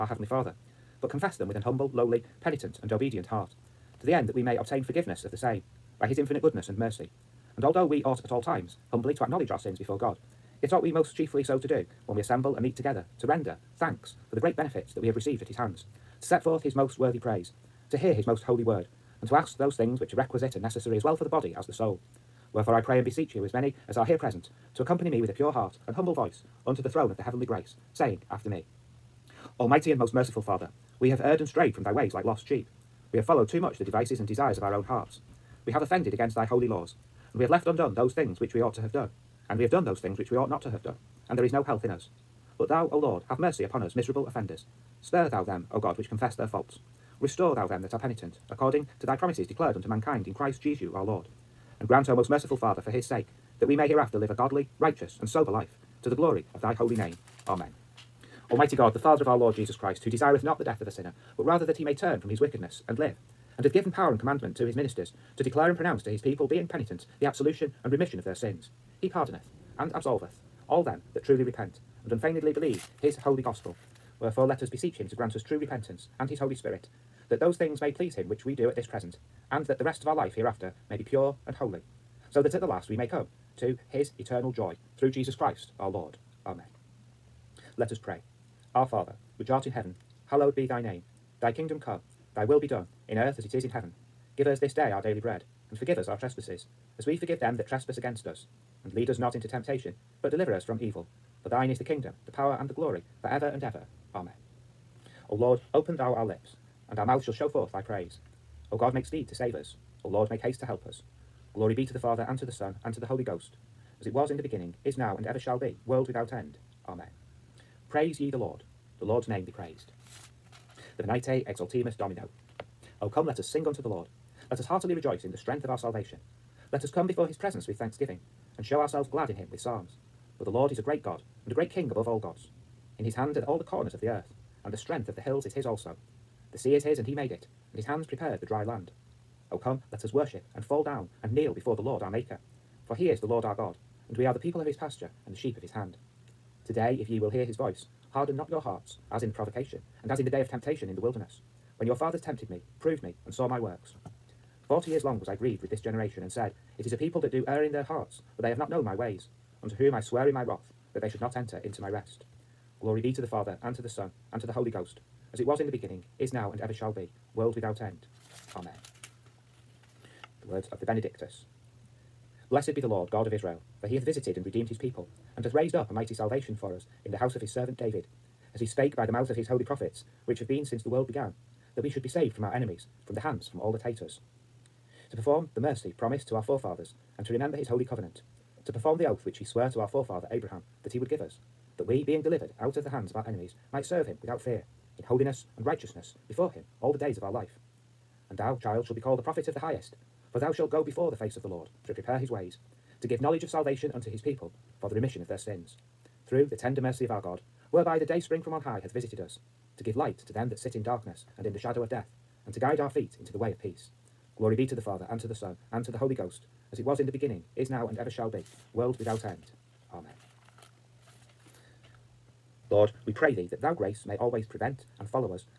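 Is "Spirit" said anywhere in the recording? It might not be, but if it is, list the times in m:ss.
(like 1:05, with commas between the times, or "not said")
1:16.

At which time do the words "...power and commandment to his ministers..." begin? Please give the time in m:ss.
1:03.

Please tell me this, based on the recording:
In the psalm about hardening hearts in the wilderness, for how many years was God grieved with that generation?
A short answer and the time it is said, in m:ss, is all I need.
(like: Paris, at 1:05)
40, at 2:34.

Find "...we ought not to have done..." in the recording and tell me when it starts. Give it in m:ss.
0:40.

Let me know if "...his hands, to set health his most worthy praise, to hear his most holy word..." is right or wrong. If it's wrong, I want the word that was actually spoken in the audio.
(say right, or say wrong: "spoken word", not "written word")
wrong: "forth", not "health".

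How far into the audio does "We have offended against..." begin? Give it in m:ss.
0:35.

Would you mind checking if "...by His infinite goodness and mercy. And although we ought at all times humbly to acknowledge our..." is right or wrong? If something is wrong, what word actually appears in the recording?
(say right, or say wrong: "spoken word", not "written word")
right.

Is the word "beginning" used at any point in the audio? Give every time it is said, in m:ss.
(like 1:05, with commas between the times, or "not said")
1:54, 2:45, 3:37.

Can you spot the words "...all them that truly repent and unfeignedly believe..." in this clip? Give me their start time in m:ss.
1:10.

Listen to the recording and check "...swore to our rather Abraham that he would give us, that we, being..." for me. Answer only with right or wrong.
wrong.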